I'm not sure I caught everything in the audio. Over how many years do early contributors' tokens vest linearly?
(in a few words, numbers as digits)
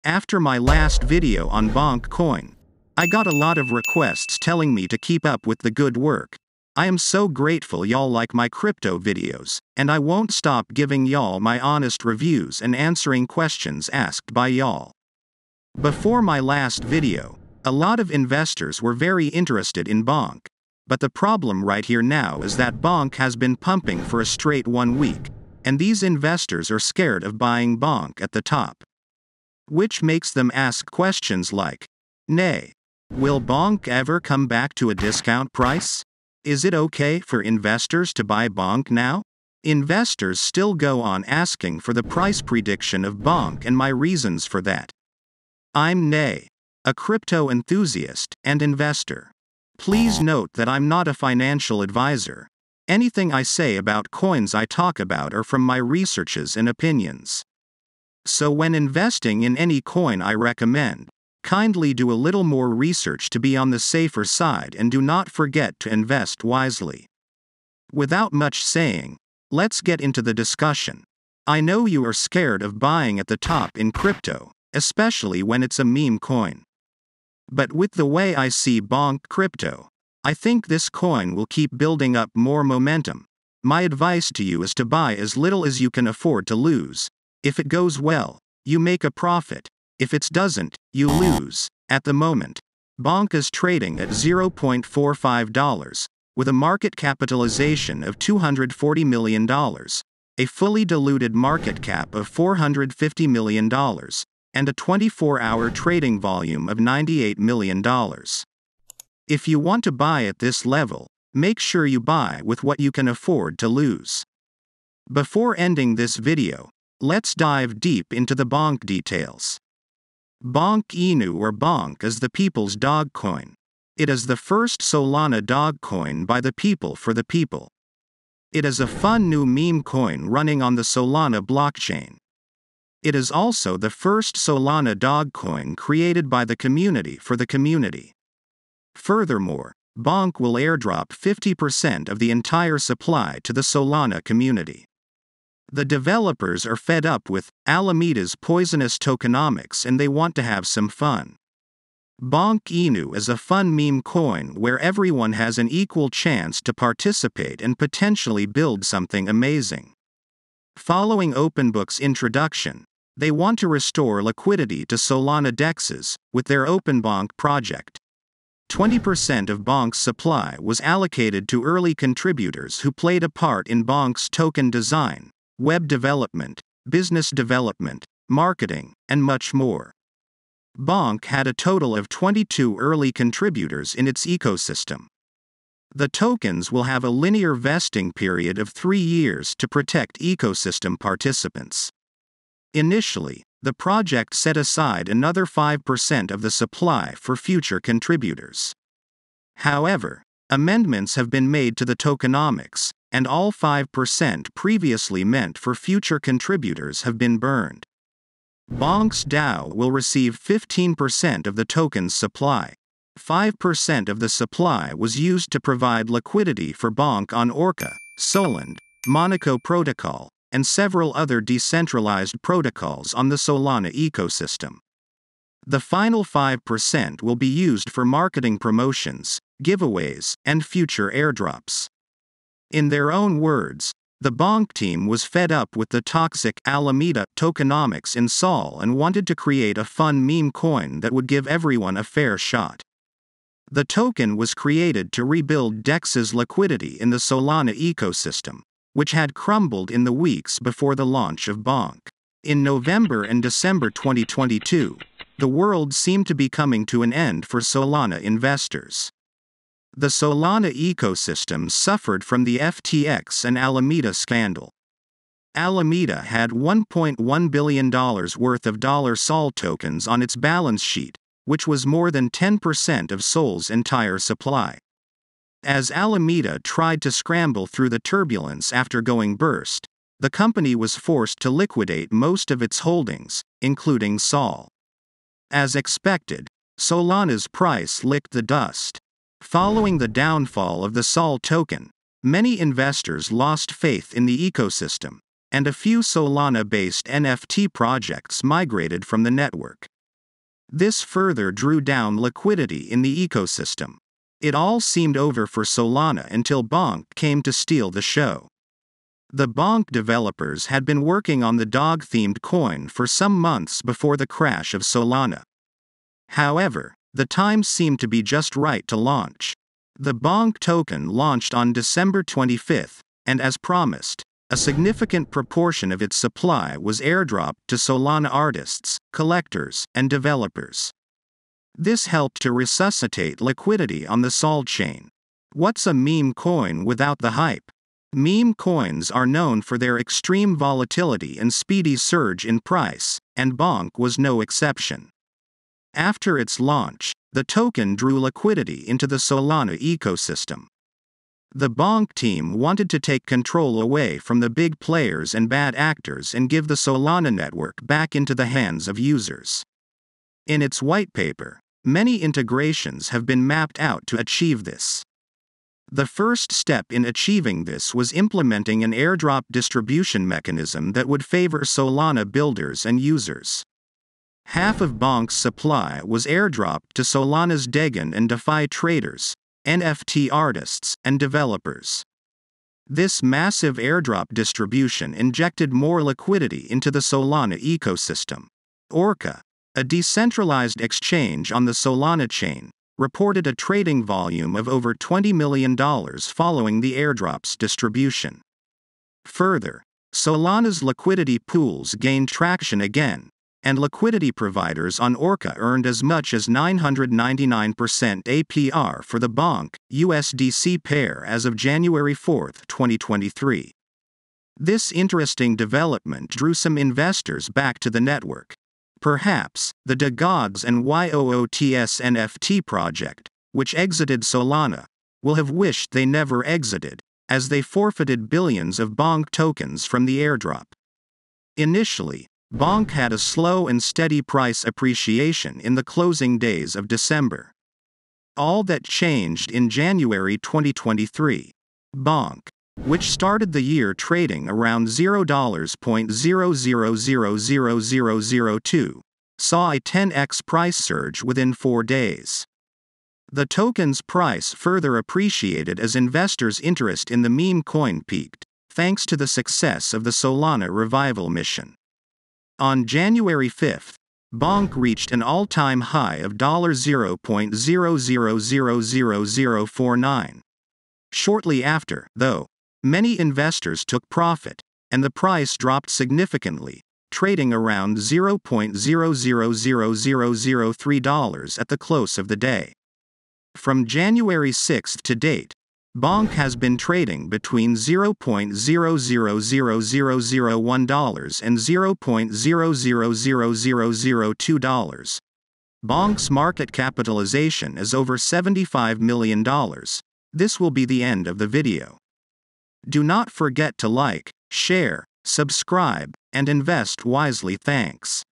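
three years.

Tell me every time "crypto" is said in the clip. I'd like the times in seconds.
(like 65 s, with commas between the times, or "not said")
8 s, 46 s, 73 s, 79 s.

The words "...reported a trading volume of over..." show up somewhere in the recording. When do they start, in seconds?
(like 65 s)
392 s.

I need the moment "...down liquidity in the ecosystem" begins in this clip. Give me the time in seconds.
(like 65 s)
301 s.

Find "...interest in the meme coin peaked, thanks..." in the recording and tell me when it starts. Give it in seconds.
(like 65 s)
456 s.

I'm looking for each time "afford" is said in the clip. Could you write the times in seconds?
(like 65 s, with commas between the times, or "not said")
86 s, 113 s.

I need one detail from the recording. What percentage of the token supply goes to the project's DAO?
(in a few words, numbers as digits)
15%.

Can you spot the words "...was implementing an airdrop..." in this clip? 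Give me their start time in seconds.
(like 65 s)
367 s.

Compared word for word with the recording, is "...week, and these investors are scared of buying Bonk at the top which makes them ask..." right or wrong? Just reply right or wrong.
right.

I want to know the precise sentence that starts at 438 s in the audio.
All that changed in January 2023.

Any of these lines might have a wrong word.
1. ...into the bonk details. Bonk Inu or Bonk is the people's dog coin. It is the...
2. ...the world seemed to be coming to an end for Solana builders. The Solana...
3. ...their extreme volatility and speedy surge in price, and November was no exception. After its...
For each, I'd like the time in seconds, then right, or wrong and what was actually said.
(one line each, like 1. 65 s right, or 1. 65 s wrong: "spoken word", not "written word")
1. 118 s right
2. 255 s wrong: "investors", not "builders"
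3. 339 s wrong: "Bonk", not "November".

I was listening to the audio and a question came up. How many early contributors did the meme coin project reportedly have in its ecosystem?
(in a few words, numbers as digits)
22.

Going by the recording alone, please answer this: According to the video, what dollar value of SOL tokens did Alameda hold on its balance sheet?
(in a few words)
$1.1 billion.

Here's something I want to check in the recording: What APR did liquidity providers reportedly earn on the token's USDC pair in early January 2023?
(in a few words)
999%.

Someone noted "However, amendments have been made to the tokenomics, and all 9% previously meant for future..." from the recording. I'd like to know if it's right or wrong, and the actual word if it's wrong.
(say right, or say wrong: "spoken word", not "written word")
wrong: "5", not "9".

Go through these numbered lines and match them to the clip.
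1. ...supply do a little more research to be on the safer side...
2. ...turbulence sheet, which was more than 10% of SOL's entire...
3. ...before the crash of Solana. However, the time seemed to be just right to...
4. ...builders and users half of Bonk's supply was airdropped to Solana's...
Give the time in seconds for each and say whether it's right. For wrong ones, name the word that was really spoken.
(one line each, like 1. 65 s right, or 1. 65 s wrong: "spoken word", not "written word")
1. 61 s wrong: "kindly", not "supply"
2. 270 s wrong: "balance", not "turbulence"
3. 313 s right
4. 372 s right.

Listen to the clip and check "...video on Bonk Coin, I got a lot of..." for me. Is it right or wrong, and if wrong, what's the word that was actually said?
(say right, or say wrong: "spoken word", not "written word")
right.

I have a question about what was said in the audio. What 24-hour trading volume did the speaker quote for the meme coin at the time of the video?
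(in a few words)
$98 million.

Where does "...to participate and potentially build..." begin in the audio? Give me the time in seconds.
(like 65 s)
156 s.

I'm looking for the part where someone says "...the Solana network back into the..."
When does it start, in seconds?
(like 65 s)
356 s.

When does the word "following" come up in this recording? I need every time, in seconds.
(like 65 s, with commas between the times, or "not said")
160 s, 289 s, 395 s.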